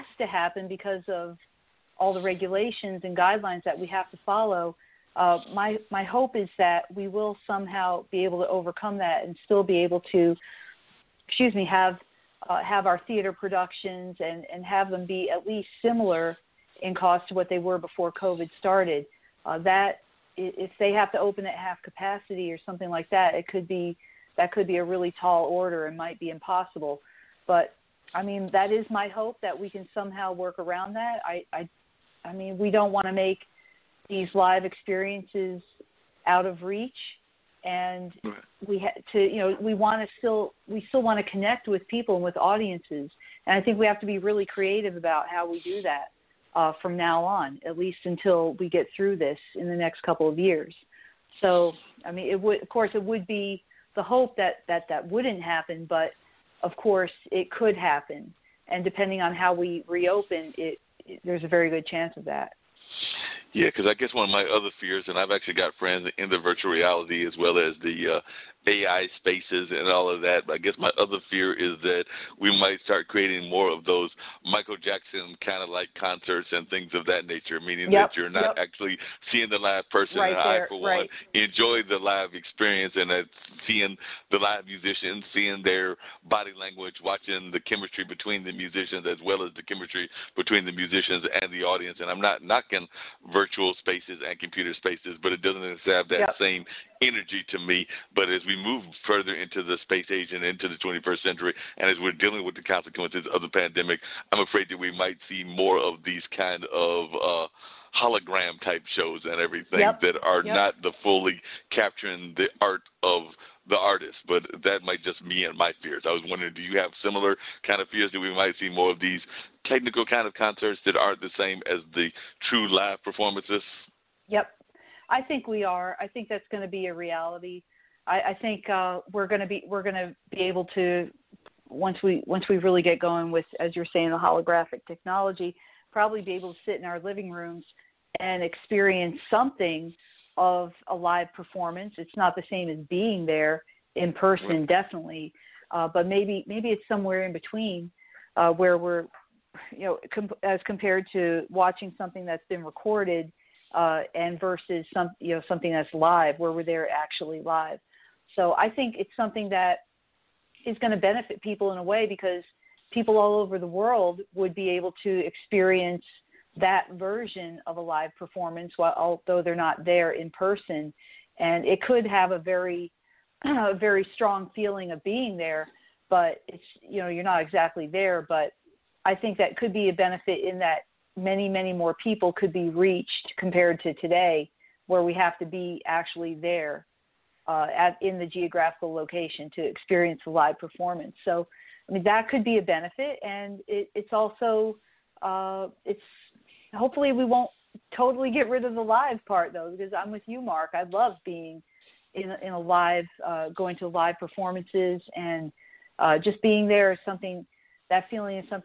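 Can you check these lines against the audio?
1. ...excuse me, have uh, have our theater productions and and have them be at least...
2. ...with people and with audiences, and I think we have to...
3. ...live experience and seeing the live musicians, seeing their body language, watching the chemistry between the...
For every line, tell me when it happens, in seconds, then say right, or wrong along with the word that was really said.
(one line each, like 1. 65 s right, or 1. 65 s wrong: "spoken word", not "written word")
1. 11 s right
2. 41 s right
3. 81 s right.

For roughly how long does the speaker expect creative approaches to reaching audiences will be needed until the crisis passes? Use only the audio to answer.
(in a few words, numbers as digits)
the next couple of years.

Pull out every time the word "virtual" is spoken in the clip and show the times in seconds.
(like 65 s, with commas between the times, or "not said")
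66 s, 93 s.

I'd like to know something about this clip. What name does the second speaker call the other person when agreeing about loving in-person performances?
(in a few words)
Mark.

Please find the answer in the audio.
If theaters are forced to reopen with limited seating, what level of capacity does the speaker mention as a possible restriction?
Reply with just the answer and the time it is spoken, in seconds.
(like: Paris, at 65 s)
half capacity, at 21 s.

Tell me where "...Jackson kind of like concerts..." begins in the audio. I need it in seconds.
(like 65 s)
74 s.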